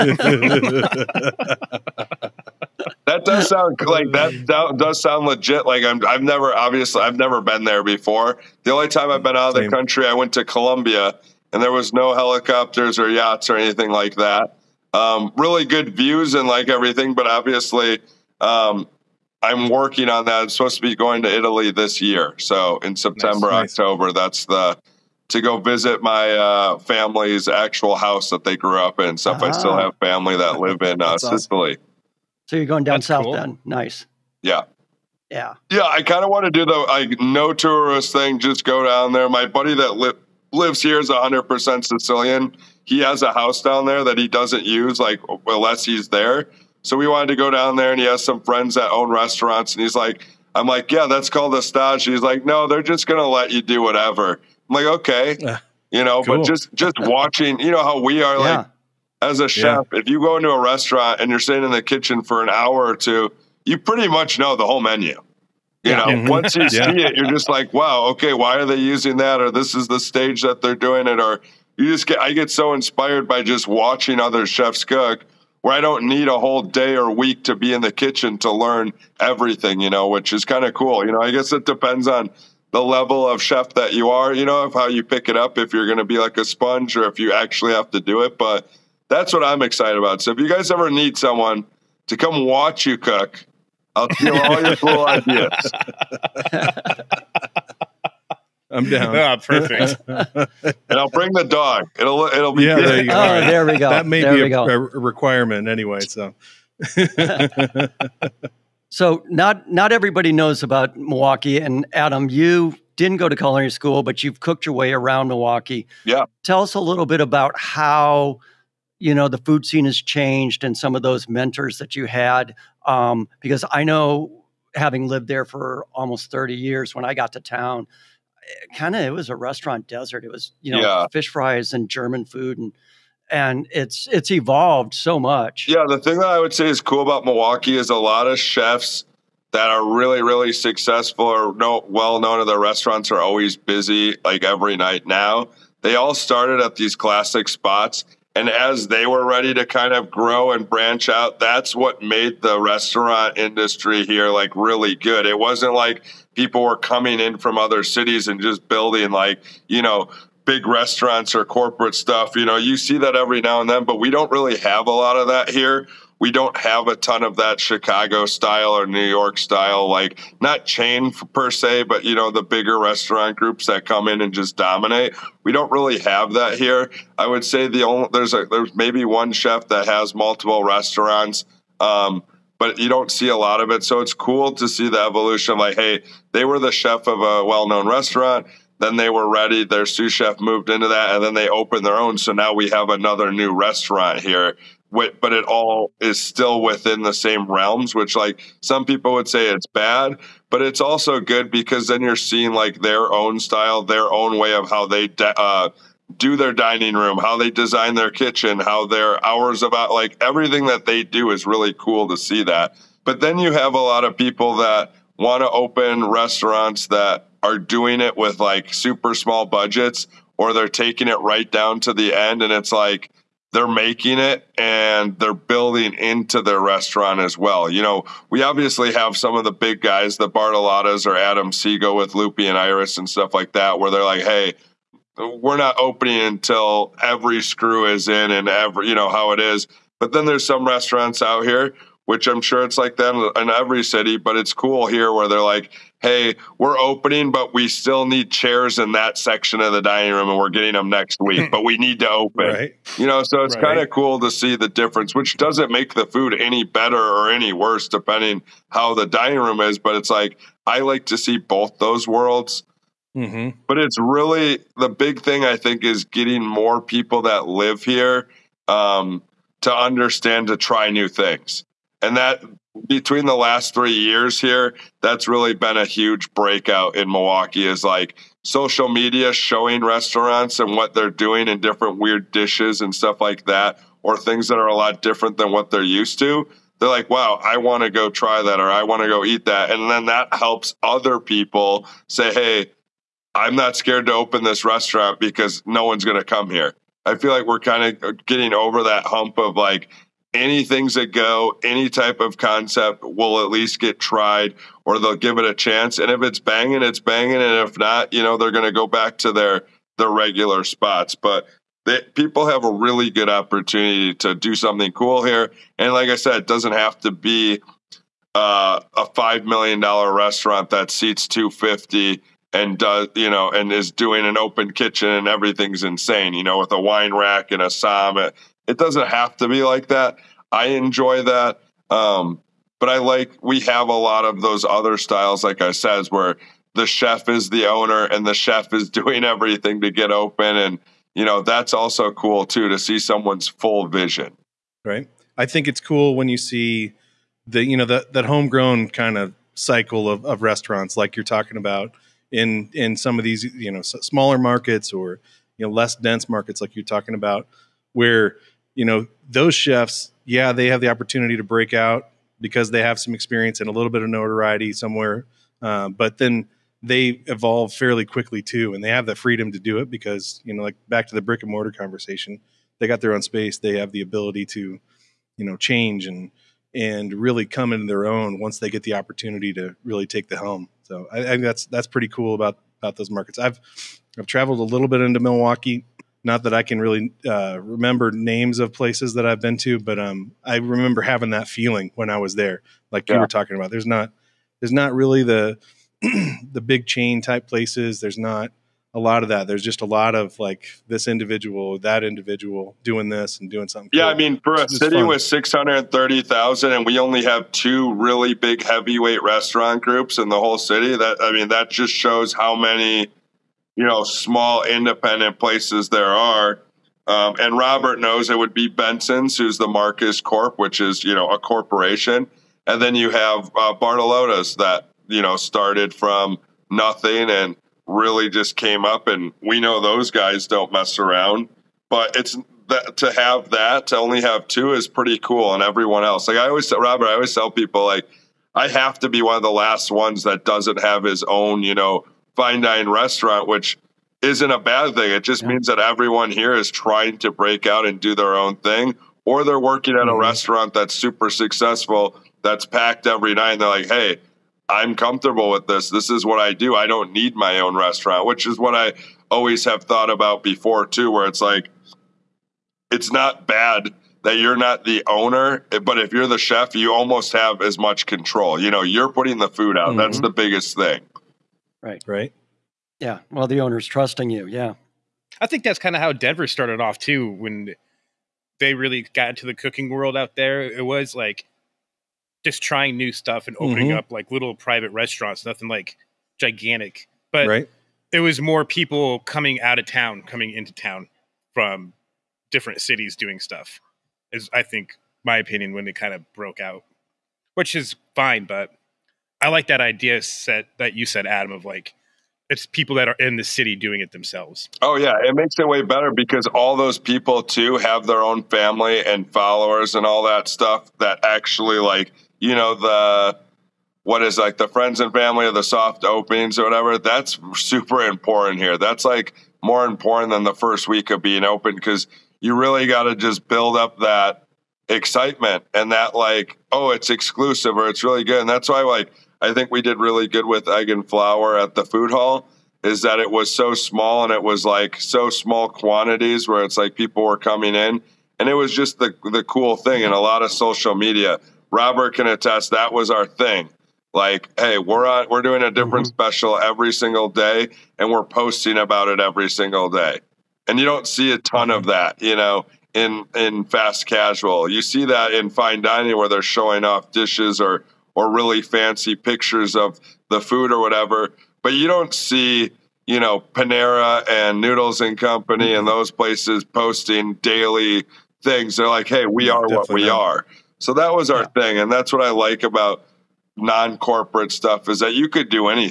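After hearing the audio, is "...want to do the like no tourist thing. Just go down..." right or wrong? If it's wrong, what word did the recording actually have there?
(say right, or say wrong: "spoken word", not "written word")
right.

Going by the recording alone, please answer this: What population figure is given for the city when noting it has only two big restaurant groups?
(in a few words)
630,000.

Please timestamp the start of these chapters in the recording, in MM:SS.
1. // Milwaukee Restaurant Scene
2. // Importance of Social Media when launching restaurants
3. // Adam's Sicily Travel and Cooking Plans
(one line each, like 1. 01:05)
1. 01:48
2. 08:25
3. 00:18.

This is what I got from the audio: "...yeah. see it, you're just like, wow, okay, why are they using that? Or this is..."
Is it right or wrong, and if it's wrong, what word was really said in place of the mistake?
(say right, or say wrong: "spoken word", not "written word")
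right.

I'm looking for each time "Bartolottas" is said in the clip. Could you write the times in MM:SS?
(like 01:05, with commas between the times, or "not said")
03:50, 07:03.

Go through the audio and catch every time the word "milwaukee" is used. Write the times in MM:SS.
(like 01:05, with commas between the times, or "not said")
01:50, 01:55, 02:17, 04:37, 06:25.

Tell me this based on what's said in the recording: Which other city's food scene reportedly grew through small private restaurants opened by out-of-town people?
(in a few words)
Denver.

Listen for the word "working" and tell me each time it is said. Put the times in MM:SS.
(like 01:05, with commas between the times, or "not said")
00:19, 07:29.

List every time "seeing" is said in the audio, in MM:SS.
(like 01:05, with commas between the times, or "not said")
03:22.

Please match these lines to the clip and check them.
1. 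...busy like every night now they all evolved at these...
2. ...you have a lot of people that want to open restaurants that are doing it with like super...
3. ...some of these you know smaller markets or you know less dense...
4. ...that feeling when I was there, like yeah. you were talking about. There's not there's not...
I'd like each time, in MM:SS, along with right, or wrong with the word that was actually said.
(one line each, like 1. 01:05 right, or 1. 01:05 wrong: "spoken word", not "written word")
1. 02:23 wrong: "started", not "evolved"
2. 03:33 right
3. 05:52 right
4. 06:31 right.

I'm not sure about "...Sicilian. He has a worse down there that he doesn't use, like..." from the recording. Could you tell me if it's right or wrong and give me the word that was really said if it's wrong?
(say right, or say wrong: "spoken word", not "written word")
wrong: "house", not "worse".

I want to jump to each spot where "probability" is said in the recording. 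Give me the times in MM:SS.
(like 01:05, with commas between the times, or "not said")
not said.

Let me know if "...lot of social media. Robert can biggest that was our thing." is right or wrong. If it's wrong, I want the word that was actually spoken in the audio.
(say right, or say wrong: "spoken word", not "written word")
wrong: "attest", not "biggest".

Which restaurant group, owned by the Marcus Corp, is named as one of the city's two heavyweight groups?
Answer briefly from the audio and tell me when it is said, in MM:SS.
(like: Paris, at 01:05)
Benson's, at 06:58.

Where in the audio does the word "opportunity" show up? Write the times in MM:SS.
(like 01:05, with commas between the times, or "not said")
05:13, 06:00, 06:18.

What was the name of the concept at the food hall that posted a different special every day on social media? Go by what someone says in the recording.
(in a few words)
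egg and flour.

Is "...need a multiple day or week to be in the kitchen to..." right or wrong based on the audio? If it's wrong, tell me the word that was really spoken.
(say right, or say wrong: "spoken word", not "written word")
wrong: "whole", not "multiple".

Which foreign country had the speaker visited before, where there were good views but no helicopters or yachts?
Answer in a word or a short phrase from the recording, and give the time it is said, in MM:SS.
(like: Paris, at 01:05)
Colombia, at 00:10.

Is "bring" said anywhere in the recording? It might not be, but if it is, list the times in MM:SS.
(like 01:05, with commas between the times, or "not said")
01:41.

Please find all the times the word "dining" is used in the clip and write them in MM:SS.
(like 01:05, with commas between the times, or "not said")
03:26, 04:09, 04:19, 09:15.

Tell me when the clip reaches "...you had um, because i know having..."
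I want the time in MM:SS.
02:01.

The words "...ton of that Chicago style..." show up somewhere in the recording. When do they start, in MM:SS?
02:46.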